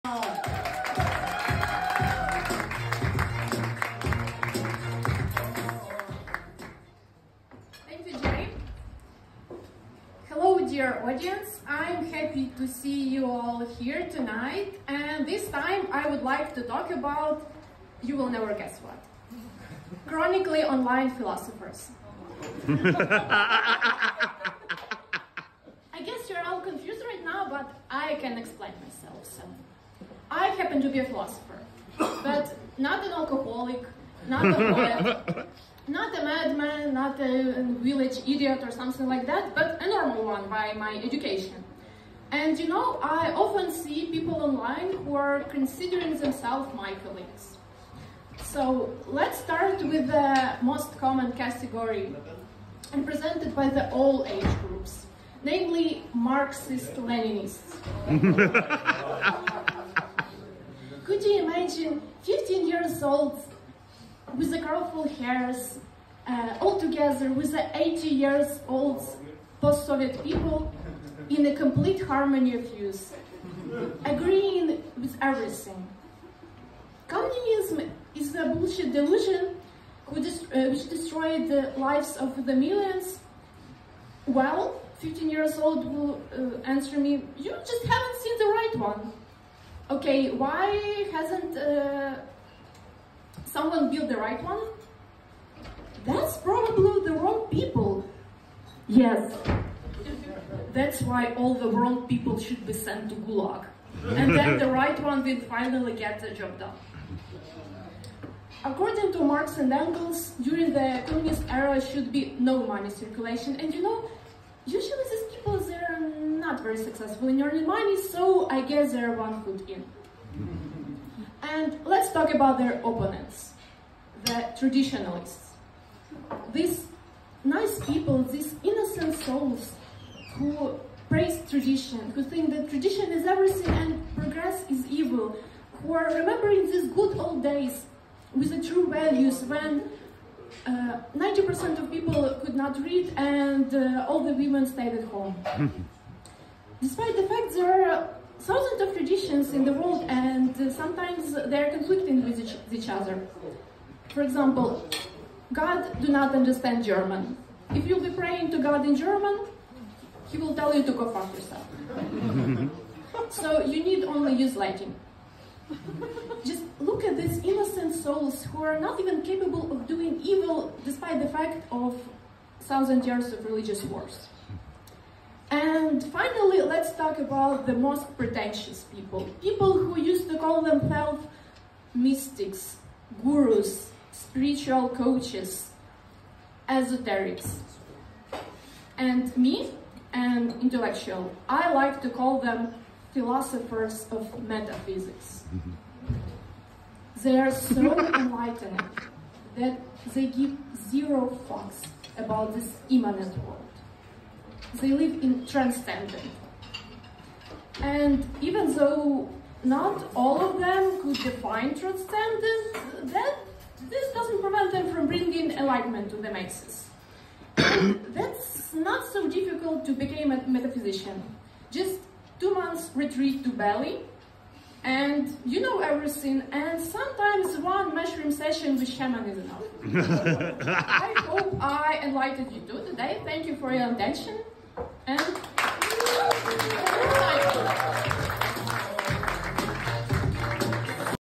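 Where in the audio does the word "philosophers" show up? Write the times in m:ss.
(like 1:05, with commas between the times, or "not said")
0:21, 0:31, 3:13.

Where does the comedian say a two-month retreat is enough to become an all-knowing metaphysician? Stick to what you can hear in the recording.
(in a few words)
Bali.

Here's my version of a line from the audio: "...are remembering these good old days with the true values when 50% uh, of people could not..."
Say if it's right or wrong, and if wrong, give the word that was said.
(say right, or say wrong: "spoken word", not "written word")
wrong: "90", not "50".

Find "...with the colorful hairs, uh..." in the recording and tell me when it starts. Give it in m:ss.
1:04.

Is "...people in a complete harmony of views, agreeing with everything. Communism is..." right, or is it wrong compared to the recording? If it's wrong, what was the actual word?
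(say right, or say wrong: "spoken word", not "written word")
right.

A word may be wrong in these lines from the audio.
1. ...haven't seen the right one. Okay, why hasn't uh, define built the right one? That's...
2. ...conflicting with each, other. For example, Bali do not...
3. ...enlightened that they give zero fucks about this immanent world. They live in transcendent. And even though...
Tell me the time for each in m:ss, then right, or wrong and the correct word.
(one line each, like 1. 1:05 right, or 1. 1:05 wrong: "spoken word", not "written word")
1. 1:27 wrong: "someone", not "define"
2. 2:31 wrong: "God", not "Bali"
3. 3:17 right.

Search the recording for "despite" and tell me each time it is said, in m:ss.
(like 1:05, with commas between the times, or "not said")
2:26, 2:50.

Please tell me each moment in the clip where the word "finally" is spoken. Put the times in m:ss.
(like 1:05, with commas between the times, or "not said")
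1:45, 2:56.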